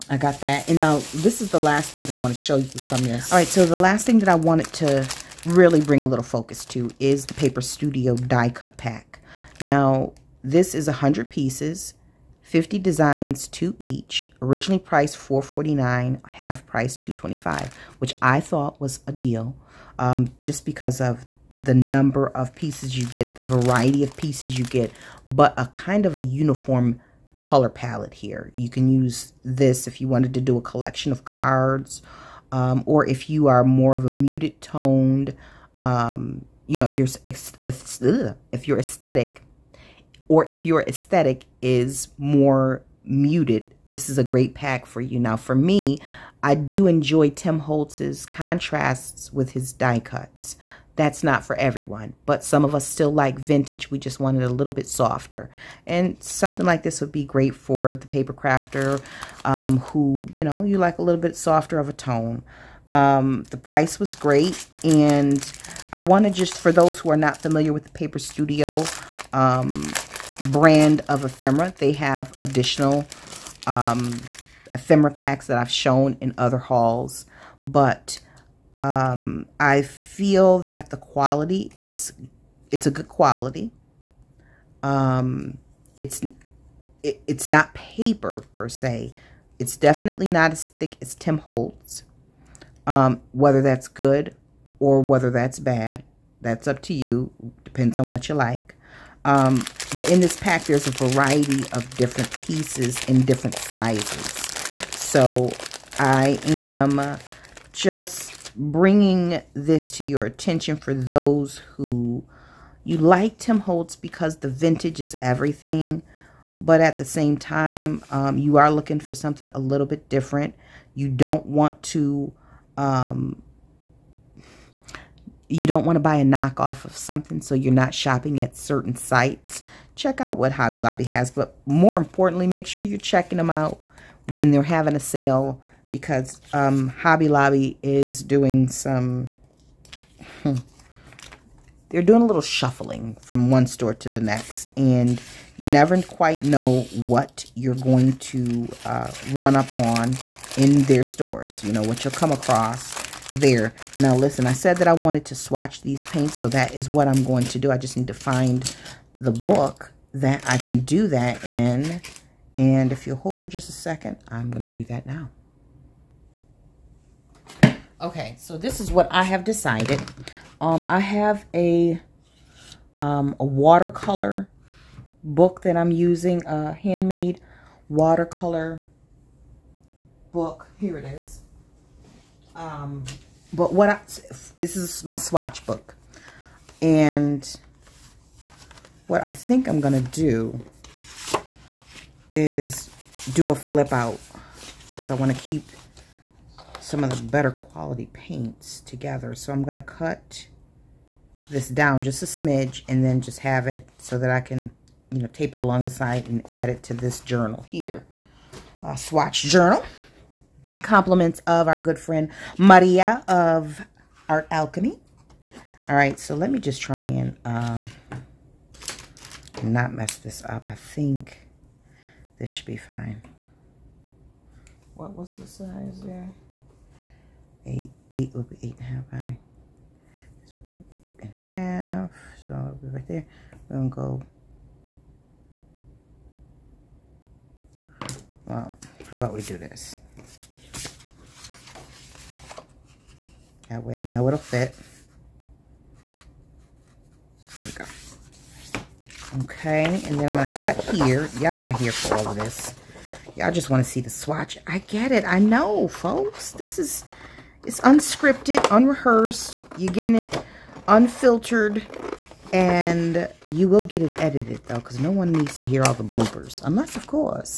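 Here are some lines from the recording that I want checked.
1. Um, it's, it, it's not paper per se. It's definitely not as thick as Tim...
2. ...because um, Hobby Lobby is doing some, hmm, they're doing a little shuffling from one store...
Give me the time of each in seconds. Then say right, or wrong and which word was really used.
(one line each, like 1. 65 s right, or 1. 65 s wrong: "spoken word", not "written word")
1. 84 s right
2. 135 s right.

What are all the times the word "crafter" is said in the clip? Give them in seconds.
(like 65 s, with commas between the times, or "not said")
58 s.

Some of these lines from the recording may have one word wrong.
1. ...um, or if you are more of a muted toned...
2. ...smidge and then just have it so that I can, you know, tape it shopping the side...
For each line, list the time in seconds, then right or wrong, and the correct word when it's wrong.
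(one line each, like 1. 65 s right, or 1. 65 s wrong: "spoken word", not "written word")
1. 32 s right
2. 202 s wrong: "along", not "shopping".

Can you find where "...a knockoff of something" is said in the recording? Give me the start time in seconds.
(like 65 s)
126 s.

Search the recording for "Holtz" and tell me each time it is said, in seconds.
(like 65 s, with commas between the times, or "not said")
47 s, 91 s, 113 s.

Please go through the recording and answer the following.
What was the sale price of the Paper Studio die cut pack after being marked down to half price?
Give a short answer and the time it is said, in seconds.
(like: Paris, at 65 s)
$2.25, at 16 s.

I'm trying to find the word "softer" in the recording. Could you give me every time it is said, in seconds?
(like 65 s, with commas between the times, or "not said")
54 s, 61 s.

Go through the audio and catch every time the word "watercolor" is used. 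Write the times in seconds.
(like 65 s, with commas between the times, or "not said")
173 s, 177 s.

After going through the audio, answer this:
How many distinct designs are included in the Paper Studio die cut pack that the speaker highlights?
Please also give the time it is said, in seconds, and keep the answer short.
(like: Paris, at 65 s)
50, at 12 s.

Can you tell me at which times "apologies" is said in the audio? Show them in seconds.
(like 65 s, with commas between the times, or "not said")
not said.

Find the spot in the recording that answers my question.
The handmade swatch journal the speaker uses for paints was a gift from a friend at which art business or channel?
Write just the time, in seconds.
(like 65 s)
214 s.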